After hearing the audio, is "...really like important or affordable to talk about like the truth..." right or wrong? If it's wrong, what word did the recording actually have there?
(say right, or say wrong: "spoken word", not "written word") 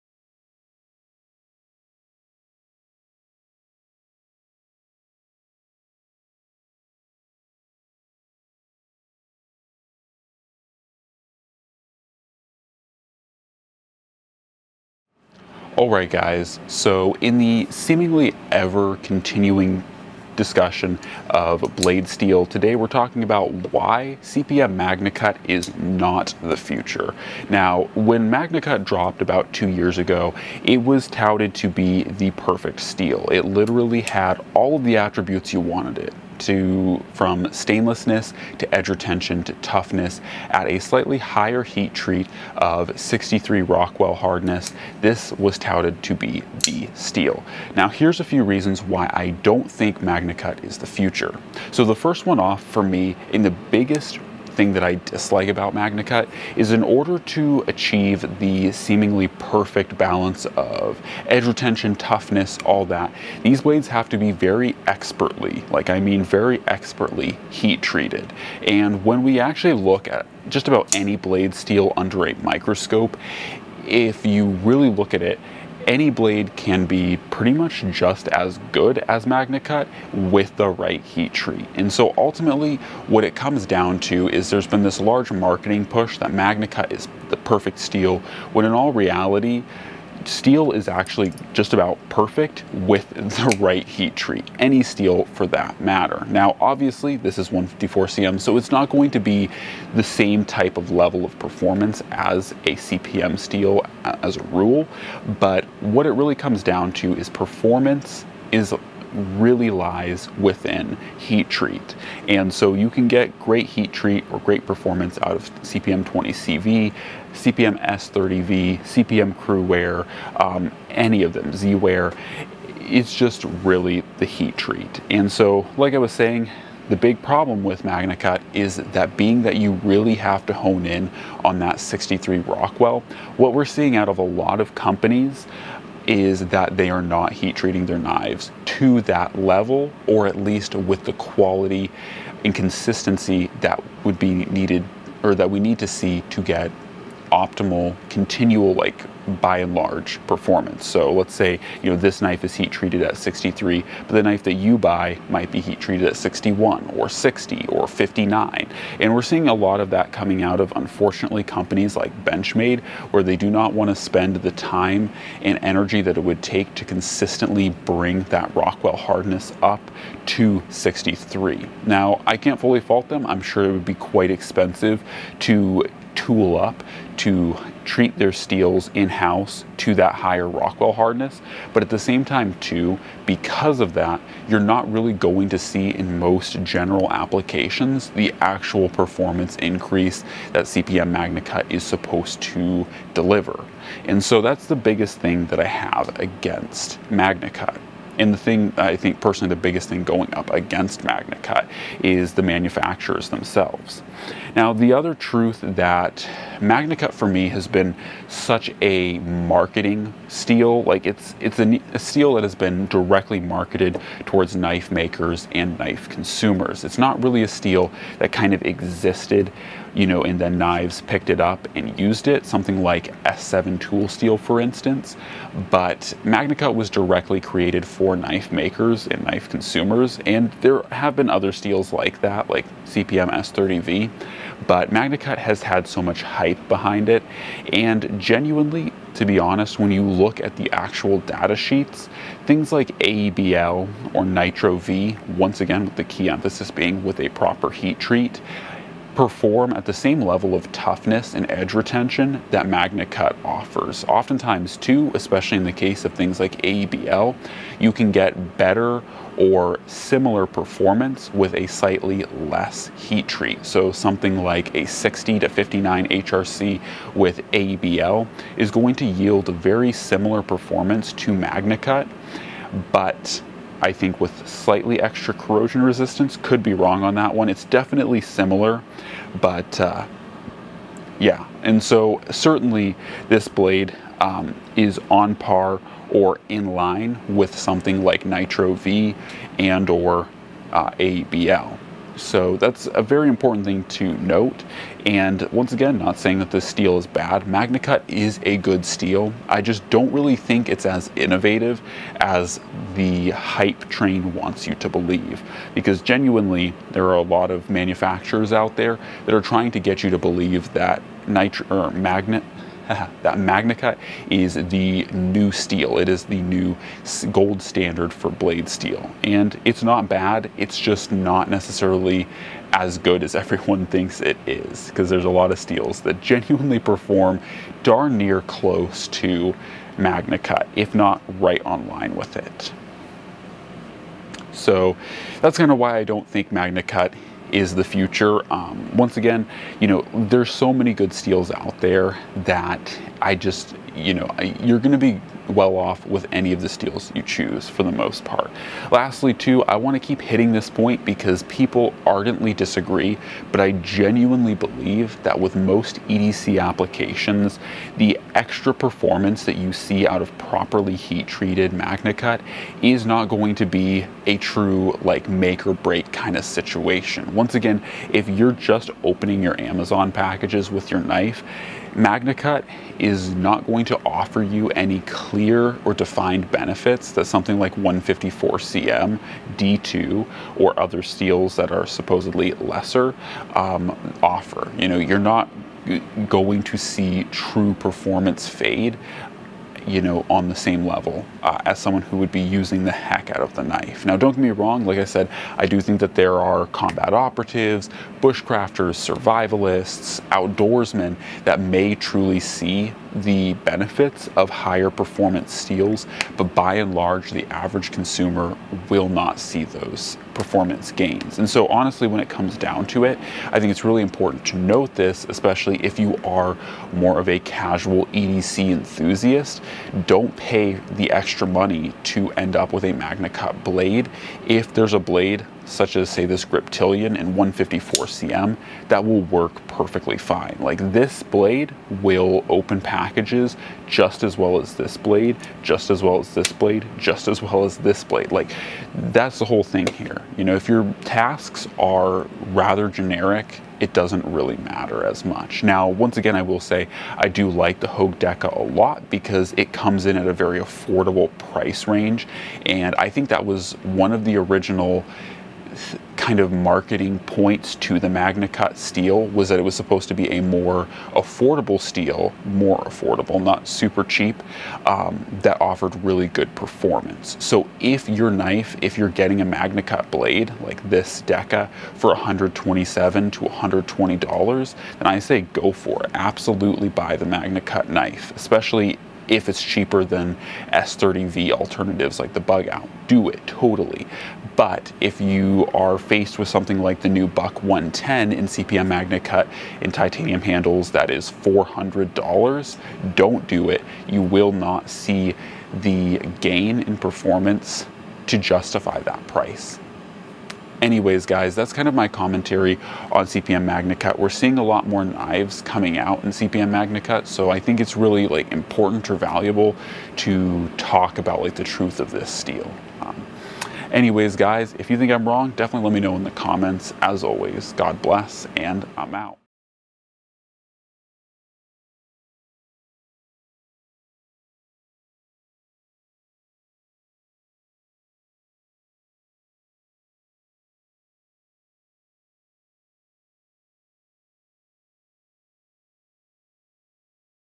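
wrong: "valuable", not "affordable".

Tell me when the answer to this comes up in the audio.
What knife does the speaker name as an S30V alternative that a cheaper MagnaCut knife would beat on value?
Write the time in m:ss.
8:02.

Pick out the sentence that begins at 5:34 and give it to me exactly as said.
So that's kind of why I don't think MagnaCut is the future.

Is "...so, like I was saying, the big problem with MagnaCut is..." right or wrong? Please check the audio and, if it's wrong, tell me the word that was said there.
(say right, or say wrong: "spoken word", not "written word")
right.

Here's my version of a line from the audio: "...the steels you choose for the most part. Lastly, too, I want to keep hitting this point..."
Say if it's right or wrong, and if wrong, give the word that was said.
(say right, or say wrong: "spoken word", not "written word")
right.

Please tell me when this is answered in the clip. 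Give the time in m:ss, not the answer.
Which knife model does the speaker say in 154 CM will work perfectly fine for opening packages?
7:06.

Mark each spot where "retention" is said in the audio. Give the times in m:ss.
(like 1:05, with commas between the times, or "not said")
0:38, 1:01, 4:11.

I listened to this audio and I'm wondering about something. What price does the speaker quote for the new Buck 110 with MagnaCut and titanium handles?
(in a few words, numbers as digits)
$400.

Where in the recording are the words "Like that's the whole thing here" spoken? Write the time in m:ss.
7:18.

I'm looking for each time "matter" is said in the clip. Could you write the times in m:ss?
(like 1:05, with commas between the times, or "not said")
1:35, 7:24.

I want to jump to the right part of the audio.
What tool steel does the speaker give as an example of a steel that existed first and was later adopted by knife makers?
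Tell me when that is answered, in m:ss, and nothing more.
3:43.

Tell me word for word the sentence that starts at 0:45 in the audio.
This was touted to be the steel.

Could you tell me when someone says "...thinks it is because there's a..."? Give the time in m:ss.
5:23.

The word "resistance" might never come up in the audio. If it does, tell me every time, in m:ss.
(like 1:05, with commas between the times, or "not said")
4:35.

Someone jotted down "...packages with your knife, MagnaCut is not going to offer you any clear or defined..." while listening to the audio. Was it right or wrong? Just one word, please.
right.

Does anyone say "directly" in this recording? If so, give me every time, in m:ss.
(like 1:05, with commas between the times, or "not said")
3:32, 3:46.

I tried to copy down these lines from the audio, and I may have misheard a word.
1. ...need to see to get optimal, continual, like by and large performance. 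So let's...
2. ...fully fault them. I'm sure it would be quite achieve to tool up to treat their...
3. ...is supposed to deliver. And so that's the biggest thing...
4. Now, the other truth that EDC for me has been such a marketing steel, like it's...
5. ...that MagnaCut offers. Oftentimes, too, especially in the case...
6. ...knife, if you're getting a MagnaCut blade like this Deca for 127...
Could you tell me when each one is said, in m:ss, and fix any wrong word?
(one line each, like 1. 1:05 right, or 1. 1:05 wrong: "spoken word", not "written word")
1. 2:25 right
2. 2:52 wrong: "expensive", not "achieve"
3. 3:11 right
4. 3:24 wrong: "MagnaCut", not "EDC"
5. 4:12 right
6. 7:48 right.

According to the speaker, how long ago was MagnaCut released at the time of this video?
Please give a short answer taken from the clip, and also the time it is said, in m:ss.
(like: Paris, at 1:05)
about 2 years, at 0:29.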